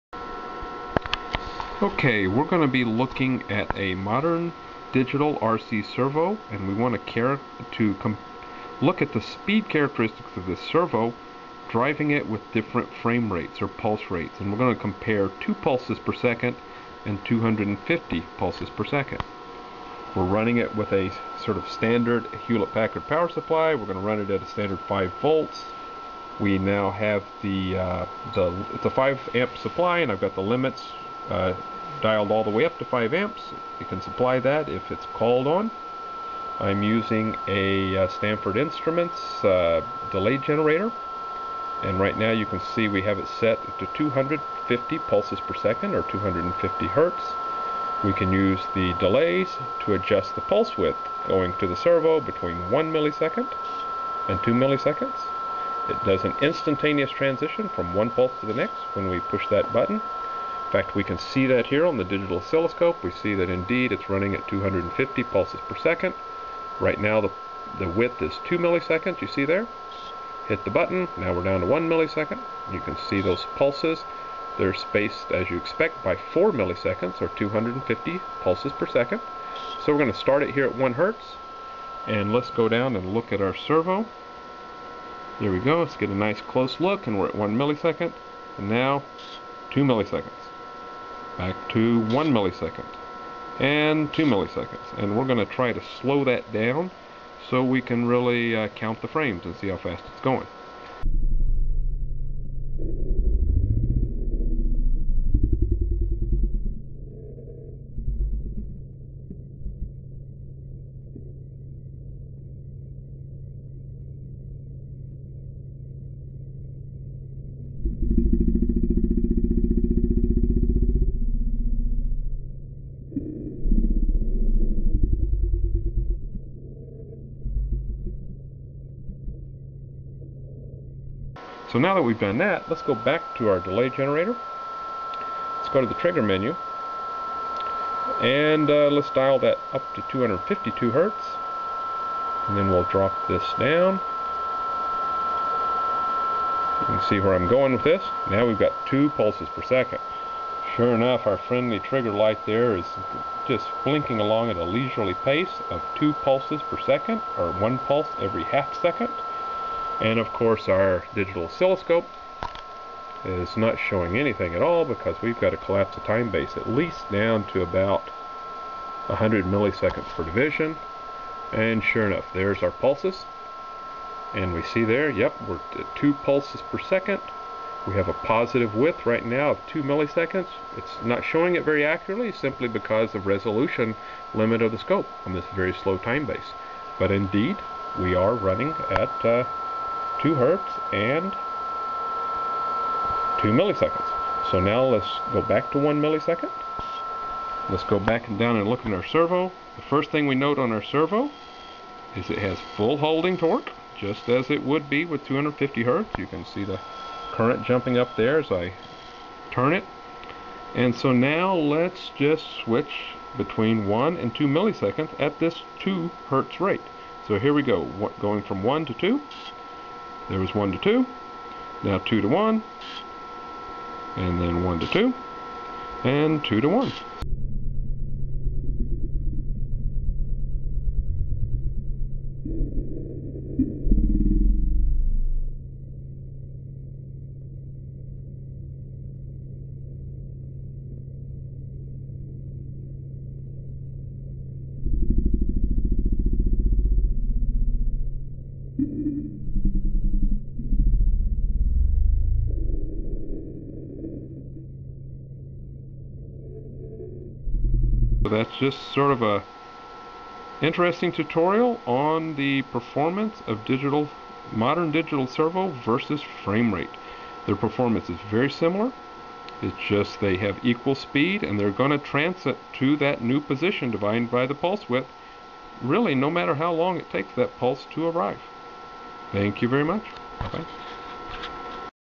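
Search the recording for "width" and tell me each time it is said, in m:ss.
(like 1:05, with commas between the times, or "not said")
0:50, 1:07, 2:58, 4:34.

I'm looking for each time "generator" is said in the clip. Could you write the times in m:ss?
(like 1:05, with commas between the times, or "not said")
0:40, 2:13.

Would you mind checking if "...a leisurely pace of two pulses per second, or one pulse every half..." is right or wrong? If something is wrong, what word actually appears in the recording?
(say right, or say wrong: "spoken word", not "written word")
right.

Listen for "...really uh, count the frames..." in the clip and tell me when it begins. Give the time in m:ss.
1:38.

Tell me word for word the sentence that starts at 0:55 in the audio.
It does an instantaneous transition from one pulse to the next when we push that button.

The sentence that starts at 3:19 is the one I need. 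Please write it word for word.
The first thing we note on our servo is it has full holding torque, just as it would be with 250 hertz.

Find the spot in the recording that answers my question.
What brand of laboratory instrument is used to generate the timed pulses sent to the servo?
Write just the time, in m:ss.
0:38.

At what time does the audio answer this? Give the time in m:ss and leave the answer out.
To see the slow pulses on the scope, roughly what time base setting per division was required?
2:49.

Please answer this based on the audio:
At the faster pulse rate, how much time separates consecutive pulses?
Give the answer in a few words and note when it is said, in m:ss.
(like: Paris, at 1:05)
4 milliseconds, at 1:16.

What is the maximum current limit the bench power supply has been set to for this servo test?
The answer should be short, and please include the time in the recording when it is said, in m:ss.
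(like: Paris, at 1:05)
5 amps, at 0:32.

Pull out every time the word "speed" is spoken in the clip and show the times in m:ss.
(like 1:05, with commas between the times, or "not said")
0:09, 4:30.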